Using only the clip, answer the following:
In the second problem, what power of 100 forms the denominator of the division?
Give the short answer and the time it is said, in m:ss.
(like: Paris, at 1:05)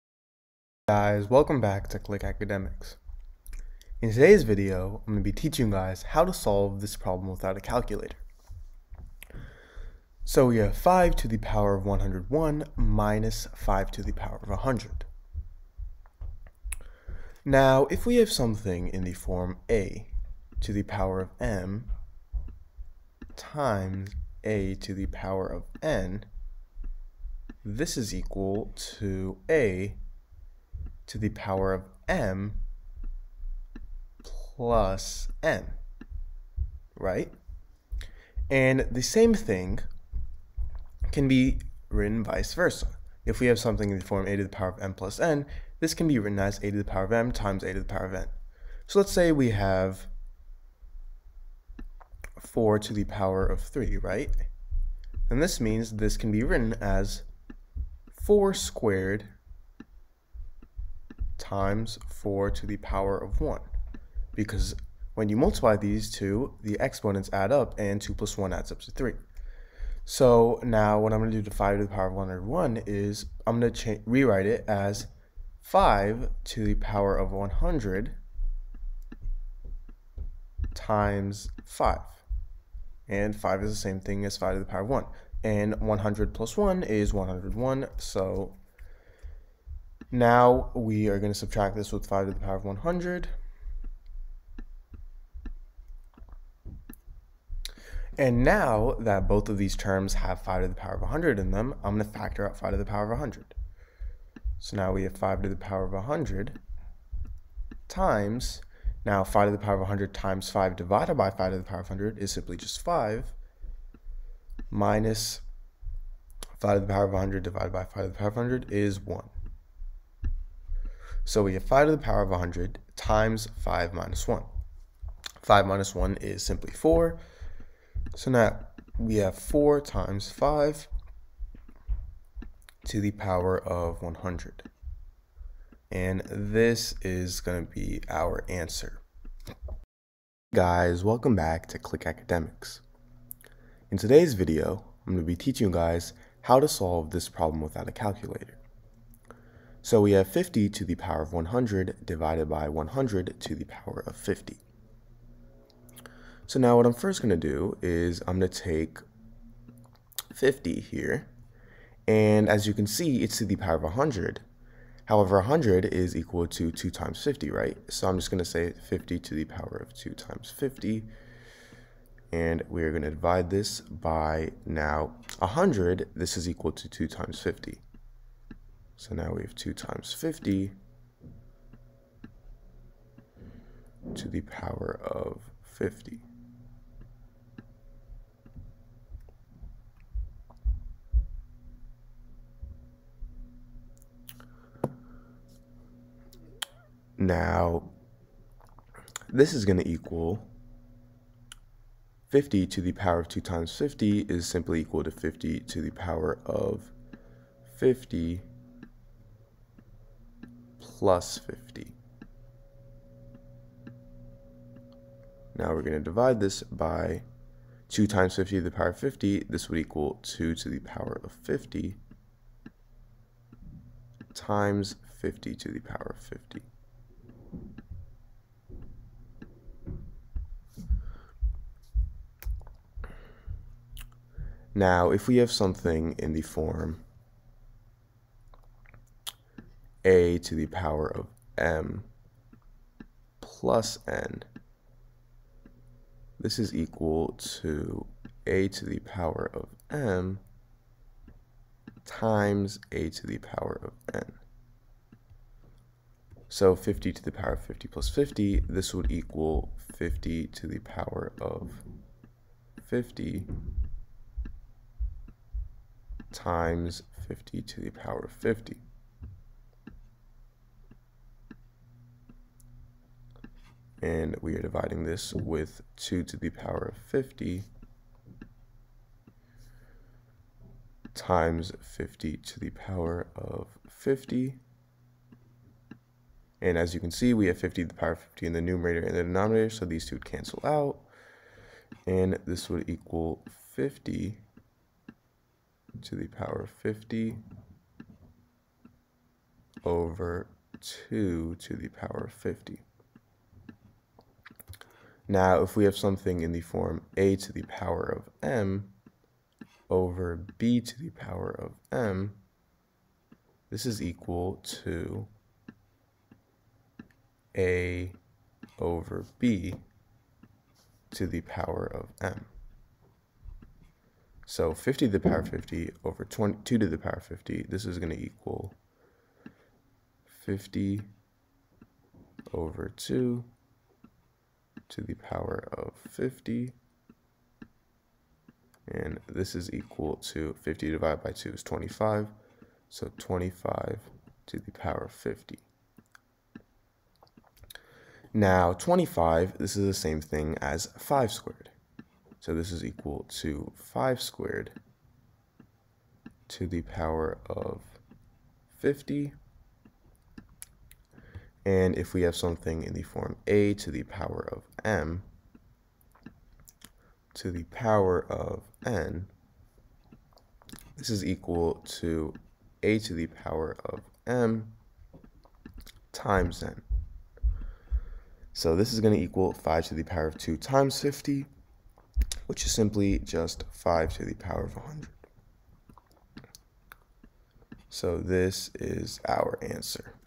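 50, at 2:32.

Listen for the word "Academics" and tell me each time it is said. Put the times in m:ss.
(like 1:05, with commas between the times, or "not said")
0:02, 2:22.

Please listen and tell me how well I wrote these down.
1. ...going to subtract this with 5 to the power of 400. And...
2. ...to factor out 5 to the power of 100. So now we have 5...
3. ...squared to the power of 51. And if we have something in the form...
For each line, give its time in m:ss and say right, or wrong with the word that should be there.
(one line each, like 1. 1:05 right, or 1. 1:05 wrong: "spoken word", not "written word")
1. 1:31 wrong: "100", not "400"
2. 1:42 right
3. 5:54 wrong: "50", not "51".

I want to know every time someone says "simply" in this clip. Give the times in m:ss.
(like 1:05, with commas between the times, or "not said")
1:52, 2:06, 3:24, 6:22.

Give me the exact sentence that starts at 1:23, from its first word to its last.
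And 5 is the same thing as 5 to the power of 1.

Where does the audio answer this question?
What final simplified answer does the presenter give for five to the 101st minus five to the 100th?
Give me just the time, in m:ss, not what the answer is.
2:09.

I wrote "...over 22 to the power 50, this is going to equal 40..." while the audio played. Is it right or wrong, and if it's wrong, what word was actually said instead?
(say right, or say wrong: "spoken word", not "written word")
wrong: "50", not "40".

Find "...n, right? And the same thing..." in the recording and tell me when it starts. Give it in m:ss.
0:35.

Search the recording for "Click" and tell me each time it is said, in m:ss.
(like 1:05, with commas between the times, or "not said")
0:01, 2:21.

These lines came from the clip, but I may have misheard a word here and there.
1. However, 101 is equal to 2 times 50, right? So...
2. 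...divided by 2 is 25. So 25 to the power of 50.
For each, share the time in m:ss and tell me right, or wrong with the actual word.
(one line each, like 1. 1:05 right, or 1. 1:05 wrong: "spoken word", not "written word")
1. 2:45 wrong: "100", not "101"
2. 5:40 right.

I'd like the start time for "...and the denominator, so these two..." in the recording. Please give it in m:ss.
4:49.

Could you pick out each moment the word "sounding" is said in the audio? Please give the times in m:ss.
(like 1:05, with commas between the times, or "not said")
not said.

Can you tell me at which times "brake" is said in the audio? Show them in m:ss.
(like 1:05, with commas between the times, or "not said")
not said.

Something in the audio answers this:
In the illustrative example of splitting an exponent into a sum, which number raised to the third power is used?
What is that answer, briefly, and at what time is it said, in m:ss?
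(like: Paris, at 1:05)
4, at 0:52.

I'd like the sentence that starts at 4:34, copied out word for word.
and we are dividing this with 2 to the power of 50 times 50 to the power of 50.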